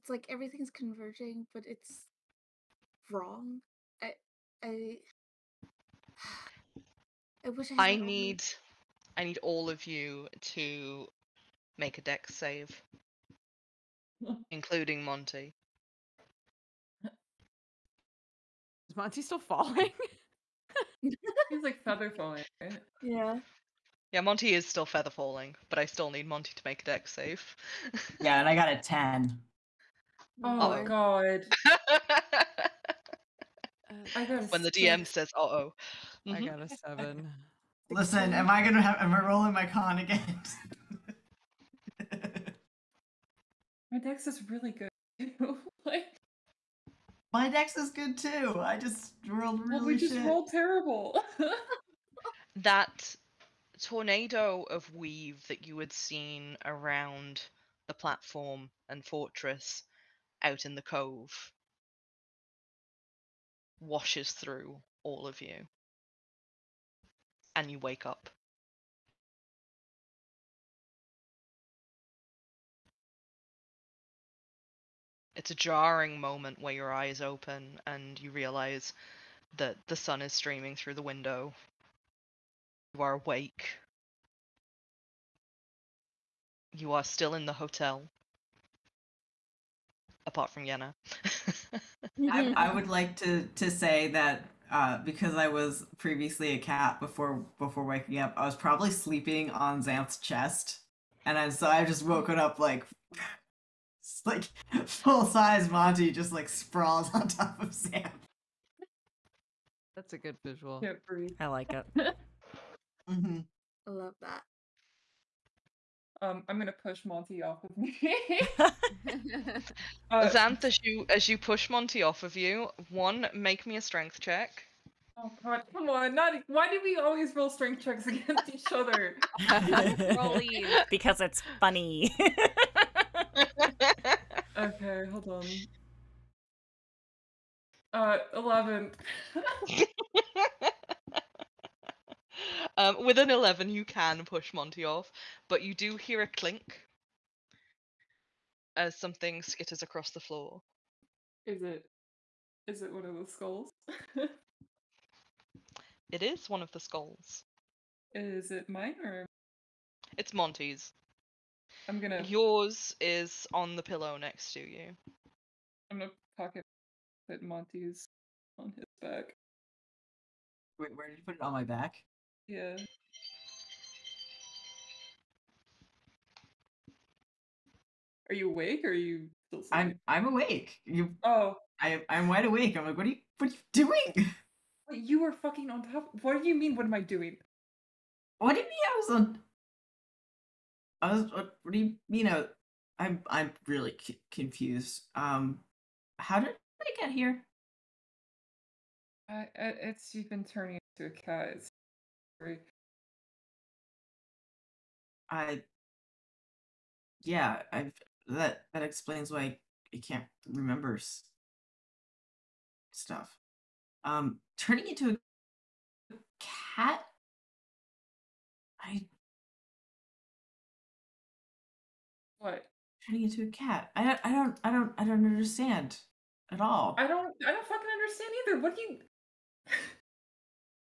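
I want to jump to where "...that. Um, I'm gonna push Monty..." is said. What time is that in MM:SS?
01:54.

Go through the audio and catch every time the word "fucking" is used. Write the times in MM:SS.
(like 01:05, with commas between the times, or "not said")
03:05, 03:47.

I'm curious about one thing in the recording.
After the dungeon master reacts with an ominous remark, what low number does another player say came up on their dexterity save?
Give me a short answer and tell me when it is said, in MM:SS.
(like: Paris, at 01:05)
7, at 00:36.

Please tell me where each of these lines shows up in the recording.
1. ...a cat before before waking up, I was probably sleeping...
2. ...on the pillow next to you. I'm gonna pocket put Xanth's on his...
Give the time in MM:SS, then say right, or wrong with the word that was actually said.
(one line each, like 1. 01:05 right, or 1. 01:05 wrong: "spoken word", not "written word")
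1. 01:36 right
2. 02:43 wrong: "Monty", not "Xanth".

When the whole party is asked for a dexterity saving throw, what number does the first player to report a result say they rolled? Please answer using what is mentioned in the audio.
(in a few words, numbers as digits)
10.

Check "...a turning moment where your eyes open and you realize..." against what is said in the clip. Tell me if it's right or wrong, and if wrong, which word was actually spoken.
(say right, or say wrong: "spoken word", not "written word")
wrong: "jarring", not "turning".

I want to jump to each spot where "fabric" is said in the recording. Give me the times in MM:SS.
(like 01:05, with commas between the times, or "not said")
not said.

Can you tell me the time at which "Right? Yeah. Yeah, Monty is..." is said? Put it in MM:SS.
00:22.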